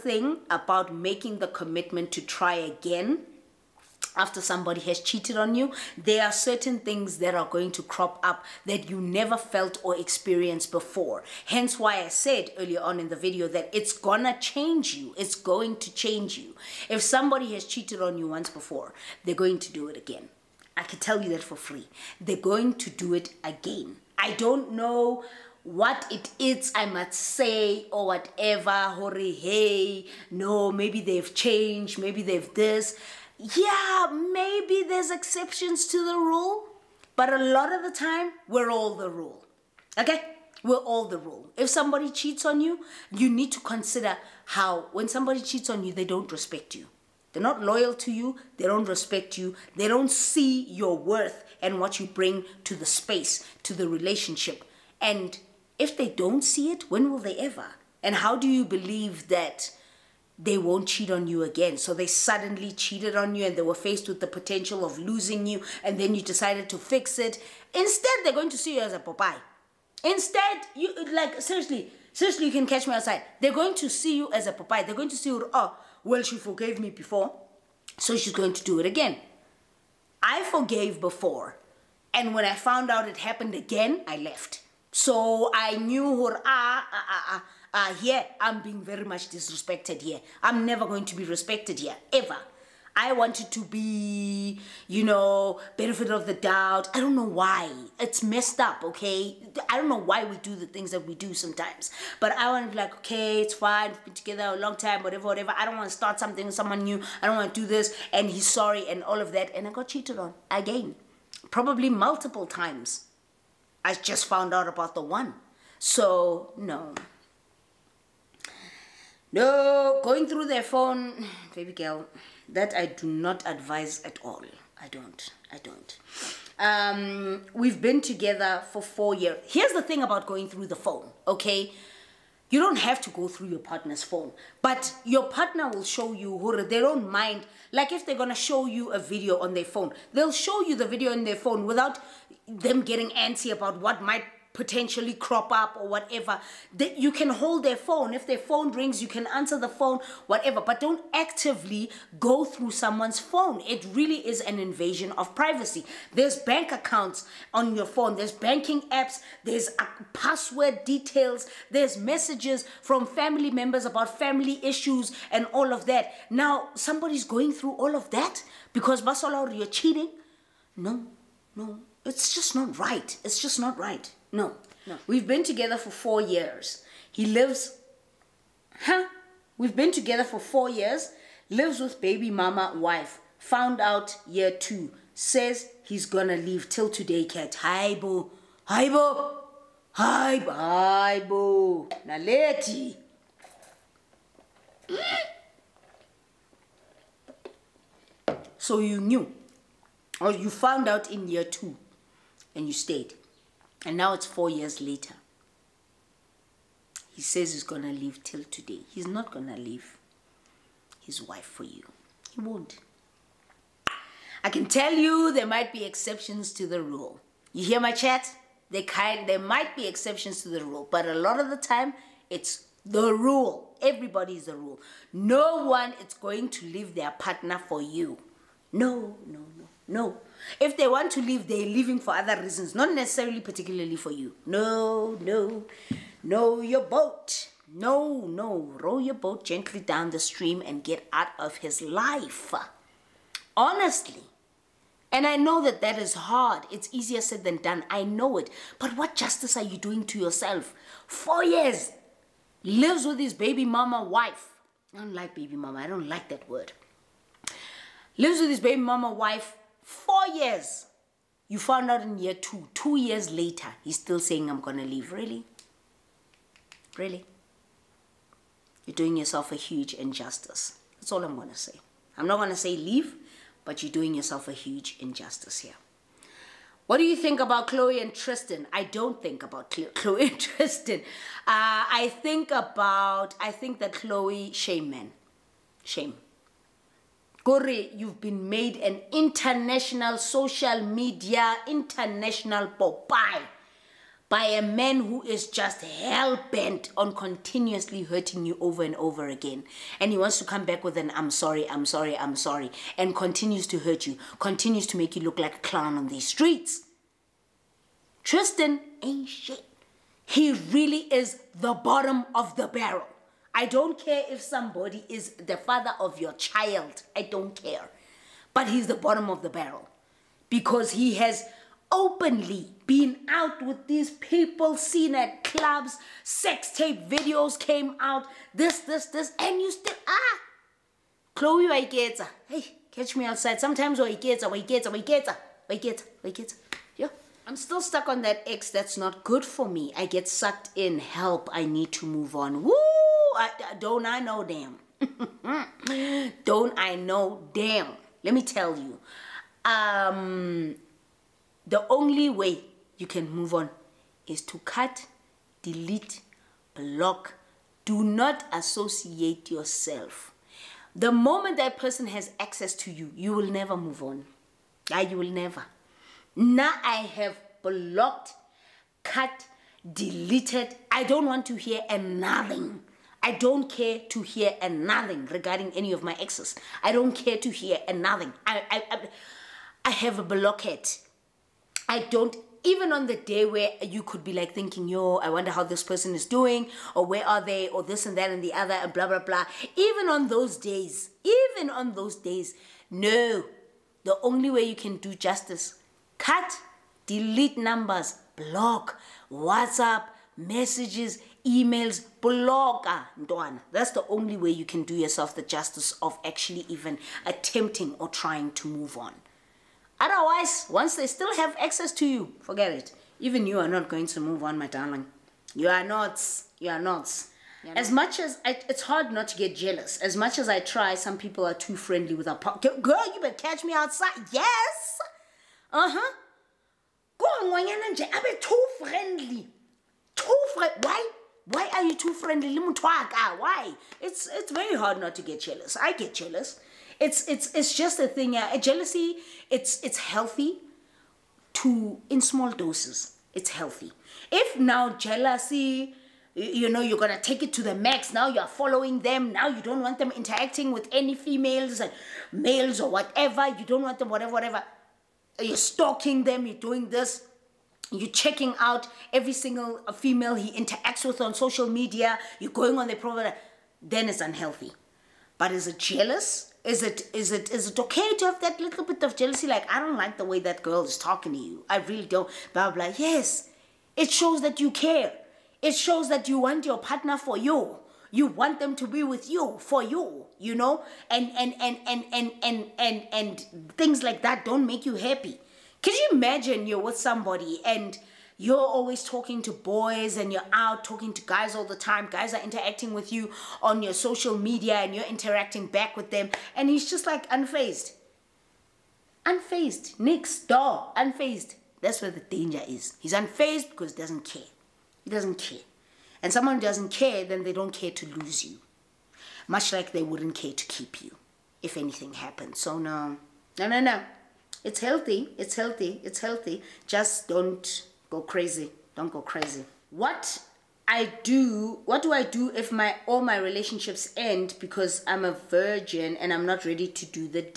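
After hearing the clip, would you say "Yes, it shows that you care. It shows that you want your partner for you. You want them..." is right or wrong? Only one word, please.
right.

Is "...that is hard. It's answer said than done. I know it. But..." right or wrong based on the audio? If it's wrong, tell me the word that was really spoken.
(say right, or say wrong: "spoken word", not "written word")
wrong: "easier", not "answer".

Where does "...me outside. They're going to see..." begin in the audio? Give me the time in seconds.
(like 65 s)
72 s.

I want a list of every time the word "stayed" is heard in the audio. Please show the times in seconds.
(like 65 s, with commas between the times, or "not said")
202 s.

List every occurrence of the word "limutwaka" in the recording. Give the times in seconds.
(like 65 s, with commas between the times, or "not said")
432 s.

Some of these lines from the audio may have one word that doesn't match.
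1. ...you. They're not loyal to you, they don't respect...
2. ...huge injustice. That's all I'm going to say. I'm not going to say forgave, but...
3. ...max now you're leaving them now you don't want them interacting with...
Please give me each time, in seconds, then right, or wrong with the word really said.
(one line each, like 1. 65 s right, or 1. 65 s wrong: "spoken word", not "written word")
1. 46 s right
2. 269 s wrong: "leave", not "forgave"
3. 447 s wrong: "following", not "leaving".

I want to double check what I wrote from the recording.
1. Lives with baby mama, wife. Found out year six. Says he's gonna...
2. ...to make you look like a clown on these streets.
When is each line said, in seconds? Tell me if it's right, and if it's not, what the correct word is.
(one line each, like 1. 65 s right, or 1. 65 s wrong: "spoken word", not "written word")
1. 181 s wrong: "two", not "six"
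2. 304 s right.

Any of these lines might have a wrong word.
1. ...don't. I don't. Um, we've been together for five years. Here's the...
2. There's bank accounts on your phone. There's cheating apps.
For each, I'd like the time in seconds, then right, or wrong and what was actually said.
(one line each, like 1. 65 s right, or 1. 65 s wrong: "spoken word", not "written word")
1. 124 s wrong: "four", not "five"
2. 156 s wrong: "banking", not "cheating".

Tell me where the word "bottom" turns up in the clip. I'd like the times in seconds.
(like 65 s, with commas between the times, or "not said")
311 s, 318 s.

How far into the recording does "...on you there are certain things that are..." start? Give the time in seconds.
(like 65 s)
5 s.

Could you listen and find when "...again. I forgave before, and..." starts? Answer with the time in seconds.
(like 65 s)
78 s.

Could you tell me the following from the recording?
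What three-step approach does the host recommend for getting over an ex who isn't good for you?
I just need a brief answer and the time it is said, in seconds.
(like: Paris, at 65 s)
cut, delete, block, at 354 s.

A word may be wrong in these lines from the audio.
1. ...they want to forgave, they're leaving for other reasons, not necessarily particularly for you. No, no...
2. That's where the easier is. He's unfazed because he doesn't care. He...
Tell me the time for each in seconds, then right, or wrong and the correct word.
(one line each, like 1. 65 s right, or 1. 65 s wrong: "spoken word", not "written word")
1. 230 s wrong: "leave", not "forgave"
2. 501 s wrong: "danger", not "easier".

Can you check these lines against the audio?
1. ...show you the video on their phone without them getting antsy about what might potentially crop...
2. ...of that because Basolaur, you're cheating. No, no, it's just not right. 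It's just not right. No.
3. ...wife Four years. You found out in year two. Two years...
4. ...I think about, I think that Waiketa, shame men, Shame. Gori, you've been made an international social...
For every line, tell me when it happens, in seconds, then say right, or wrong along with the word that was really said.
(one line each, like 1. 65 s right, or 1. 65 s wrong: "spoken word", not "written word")
1. 140 s right
2. 167 s right
3. 259 s right
4. 281 s wrong: "Khloé", not "Waiketa".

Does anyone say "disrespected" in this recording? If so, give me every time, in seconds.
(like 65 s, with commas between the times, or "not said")
89 s.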